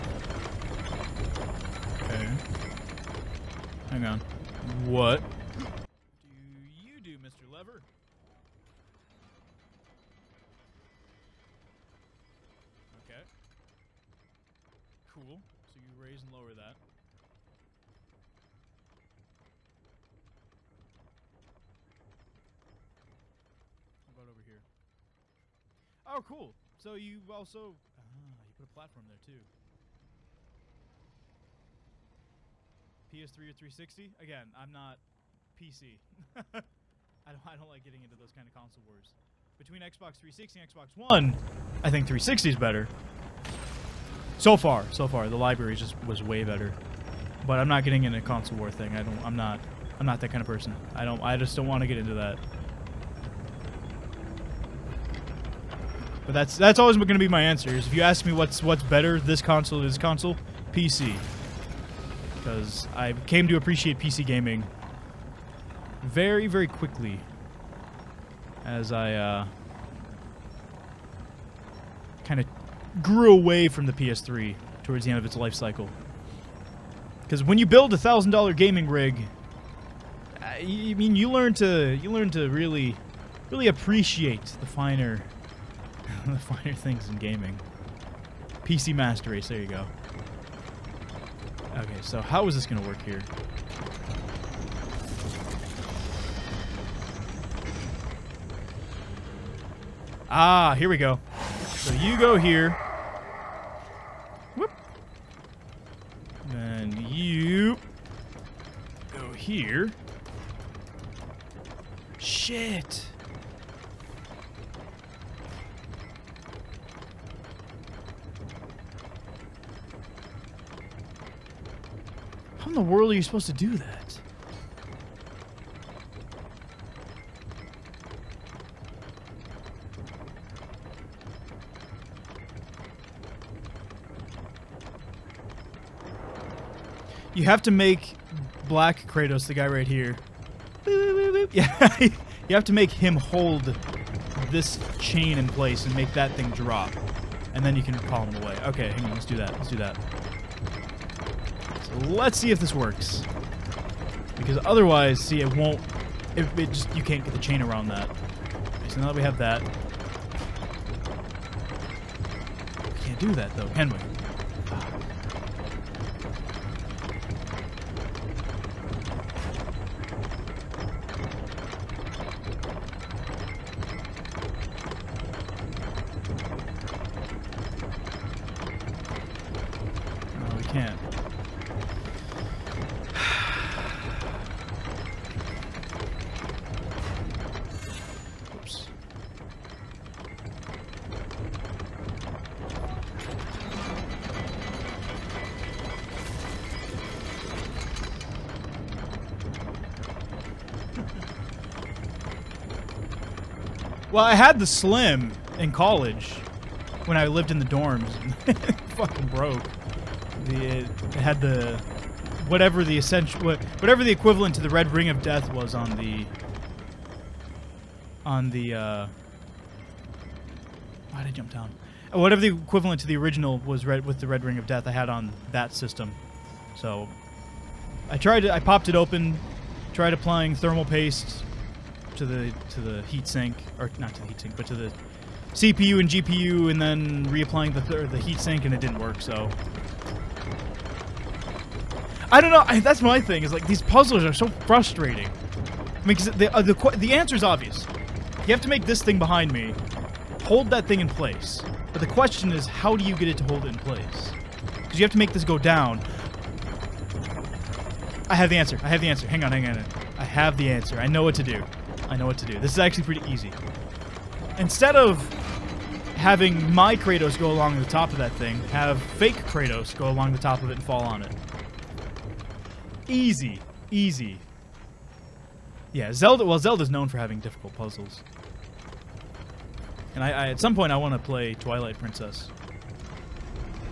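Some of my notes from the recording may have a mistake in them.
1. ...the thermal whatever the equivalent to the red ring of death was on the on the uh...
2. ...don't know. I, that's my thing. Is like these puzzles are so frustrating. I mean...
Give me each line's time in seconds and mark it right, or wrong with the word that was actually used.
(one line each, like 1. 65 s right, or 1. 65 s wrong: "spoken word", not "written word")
1. 212 s wrong: "essential", not "thermal"
2. 242 s right.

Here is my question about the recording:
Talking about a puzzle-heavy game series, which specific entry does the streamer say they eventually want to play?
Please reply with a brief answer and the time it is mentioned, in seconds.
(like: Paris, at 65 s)
Twilight Princess, at 281 s.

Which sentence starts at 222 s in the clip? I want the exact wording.
Uh, whatever the equivalent to the original was red with the red ring of death I had on that system.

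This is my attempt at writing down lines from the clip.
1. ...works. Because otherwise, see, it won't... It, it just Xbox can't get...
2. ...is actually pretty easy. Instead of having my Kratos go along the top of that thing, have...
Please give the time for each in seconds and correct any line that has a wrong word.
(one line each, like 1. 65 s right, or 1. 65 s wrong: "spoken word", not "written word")
1. 152 s wrong: "You", not "Xbox"
2. 262 s right.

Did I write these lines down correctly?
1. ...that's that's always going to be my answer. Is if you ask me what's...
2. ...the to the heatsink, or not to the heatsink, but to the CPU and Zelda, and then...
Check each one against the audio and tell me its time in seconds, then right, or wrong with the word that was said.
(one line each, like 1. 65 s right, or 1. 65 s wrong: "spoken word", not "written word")
1. 56 s right
2. 232 s wrong: "GPU", not "Zelda".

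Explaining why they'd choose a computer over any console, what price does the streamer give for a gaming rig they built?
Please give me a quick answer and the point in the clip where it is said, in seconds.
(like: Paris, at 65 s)
$1000, at 77 s.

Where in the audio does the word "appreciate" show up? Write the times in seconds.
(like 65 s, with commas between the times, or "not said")
63 s, 83 s.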